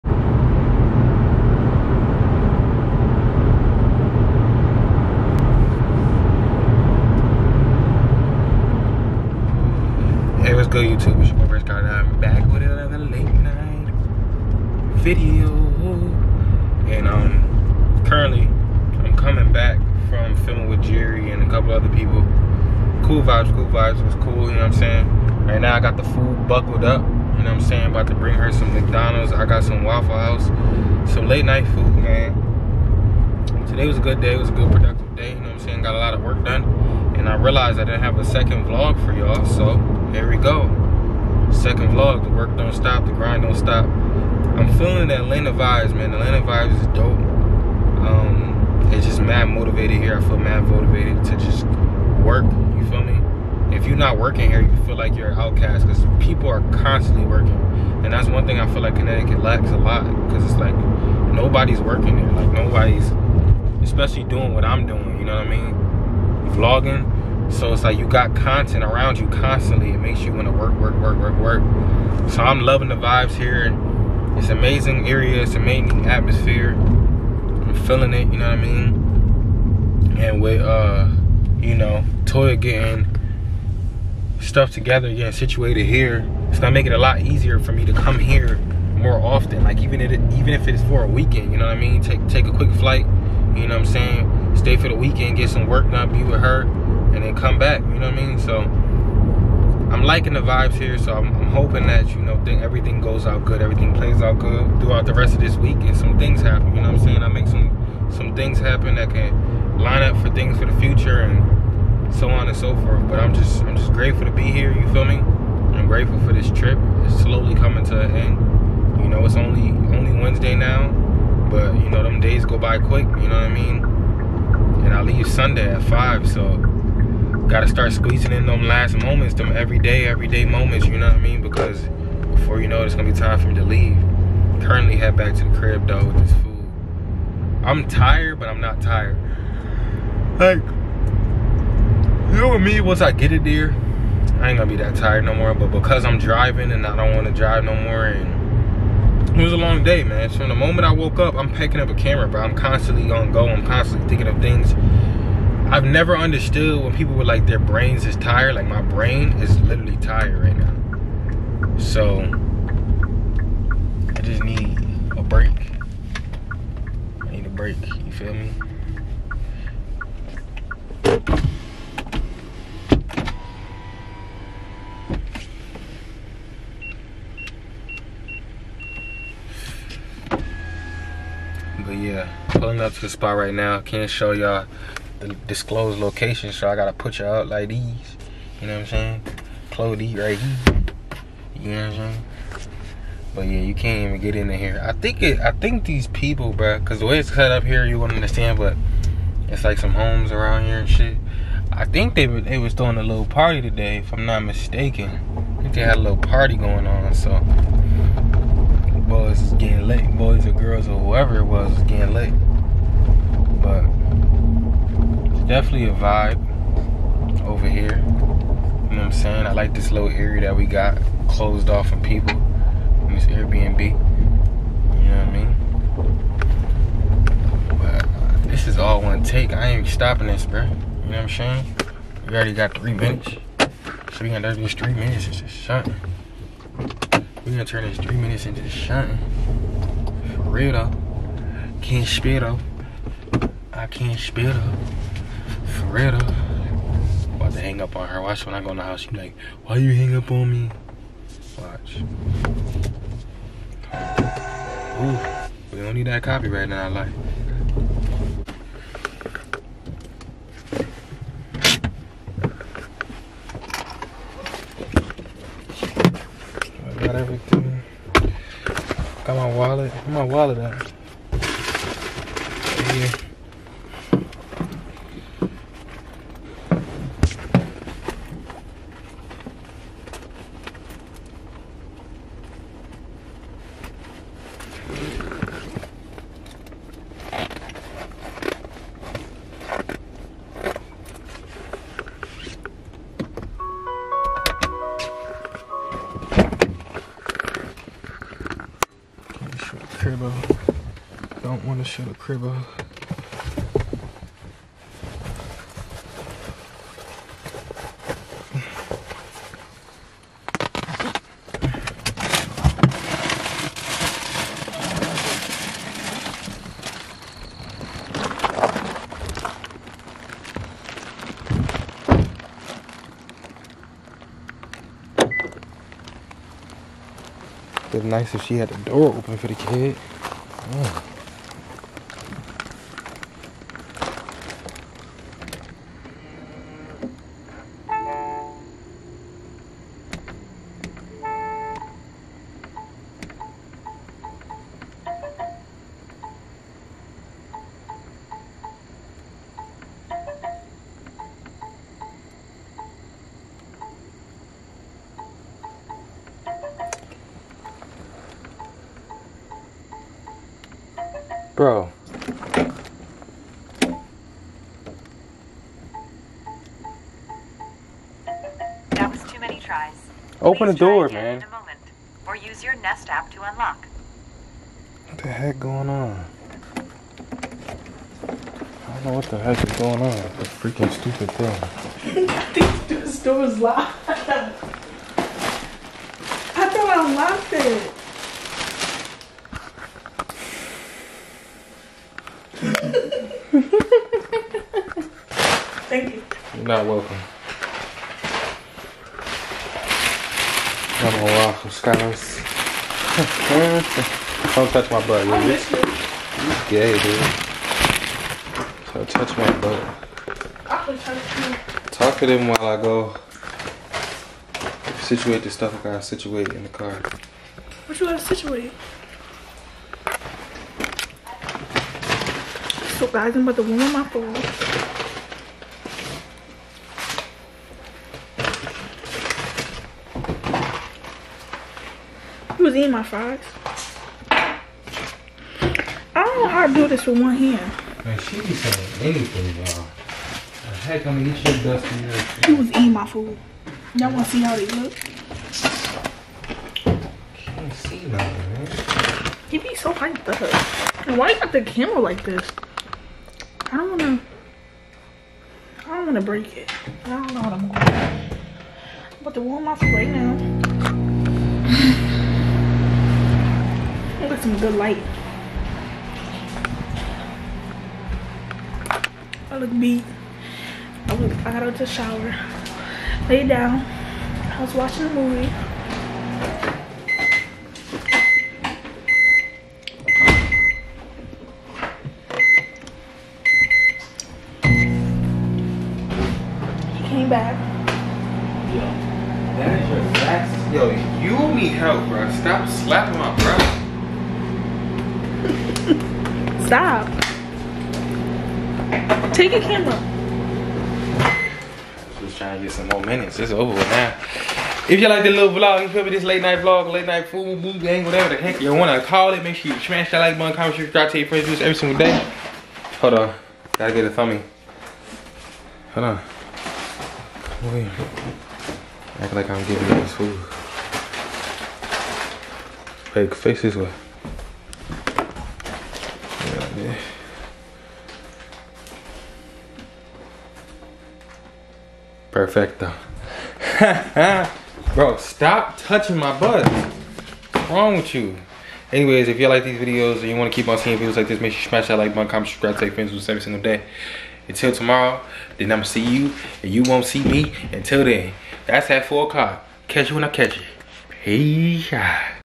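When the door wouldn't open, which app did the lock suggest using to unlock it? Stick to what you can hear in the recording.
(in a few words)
Nest.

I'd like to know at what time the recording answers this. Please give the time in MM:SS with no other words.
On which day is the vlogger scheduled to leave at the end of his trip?
02:05.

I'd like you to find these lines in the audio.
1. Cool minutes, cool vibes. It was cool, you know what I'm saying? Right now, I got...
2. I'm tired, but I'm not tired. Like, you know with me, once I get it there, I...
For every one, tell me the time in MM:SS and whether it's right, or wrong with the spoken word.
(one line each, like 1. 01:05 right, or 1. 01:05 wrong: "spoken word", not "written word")
1. 00:23 wrong: "vibes", not "minutes"
2. 02:17 right.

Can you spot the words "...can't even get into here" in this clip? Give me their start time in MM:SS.
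03:13.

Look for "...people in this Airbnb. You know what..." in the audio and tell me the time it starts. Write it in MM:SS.
03:42.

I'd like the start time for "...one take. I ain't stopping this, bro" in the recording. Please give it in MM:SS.
03:49.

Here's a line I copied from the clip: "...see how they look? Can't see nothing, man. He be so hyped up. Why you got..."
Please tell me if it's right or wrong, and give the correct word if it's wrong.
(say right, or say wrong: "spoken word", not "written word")
right.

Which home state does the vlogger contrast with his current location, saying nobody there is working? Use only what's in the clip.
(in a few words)
Connecticut.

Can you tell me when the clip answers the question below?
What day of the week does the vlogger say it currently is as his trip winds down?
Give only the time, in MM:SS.
02:00.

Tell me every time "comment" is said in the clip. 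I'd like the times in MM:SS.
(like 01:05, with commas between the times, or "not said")
08:30, 09:02.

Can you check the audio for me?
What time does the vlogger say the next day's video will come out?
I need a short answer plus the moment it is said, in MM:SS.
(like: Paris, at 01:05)
4 o'clock, at 09:09.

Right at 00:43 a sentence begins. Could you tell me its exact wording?
I'm feeling the Atlanta vibes, man.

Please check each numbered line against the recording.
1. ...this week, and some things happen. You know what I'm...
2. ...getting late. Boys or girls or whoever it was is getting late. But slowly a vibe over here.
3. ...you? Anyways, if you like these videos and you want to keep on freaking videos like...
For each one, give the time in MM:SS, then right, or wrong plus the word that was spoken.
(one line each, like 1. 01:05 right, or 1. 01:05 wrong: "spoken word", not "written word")
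1. 01:45 right
2. 03:29 wrong: "definitely", not "slowly"
3. 08:58 wrong: "seeing", not "freaking".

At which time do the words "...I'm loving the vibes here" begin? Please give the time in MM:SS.
01:12.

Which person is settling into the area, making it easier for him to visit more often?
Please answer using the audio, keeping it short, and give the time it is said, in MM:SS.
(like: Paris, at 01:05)
Toya, at 01:22.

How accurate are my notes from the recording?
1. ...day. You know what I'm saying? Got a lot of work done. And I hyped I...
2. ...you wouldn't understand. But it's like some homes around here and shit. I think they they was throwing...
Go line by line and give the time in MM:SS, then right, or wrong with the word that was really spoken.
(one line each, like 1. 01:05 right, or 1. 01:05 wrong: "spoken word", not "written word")
1. 00:35 wrong: "realized", not "hyped"
2. 03:17 right.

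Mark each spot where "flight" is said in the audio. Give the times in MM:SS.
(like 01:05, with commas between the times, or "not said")
01:32.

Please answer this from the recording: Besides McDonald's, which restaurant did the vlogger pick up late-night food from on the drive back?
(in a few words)
Waffle House.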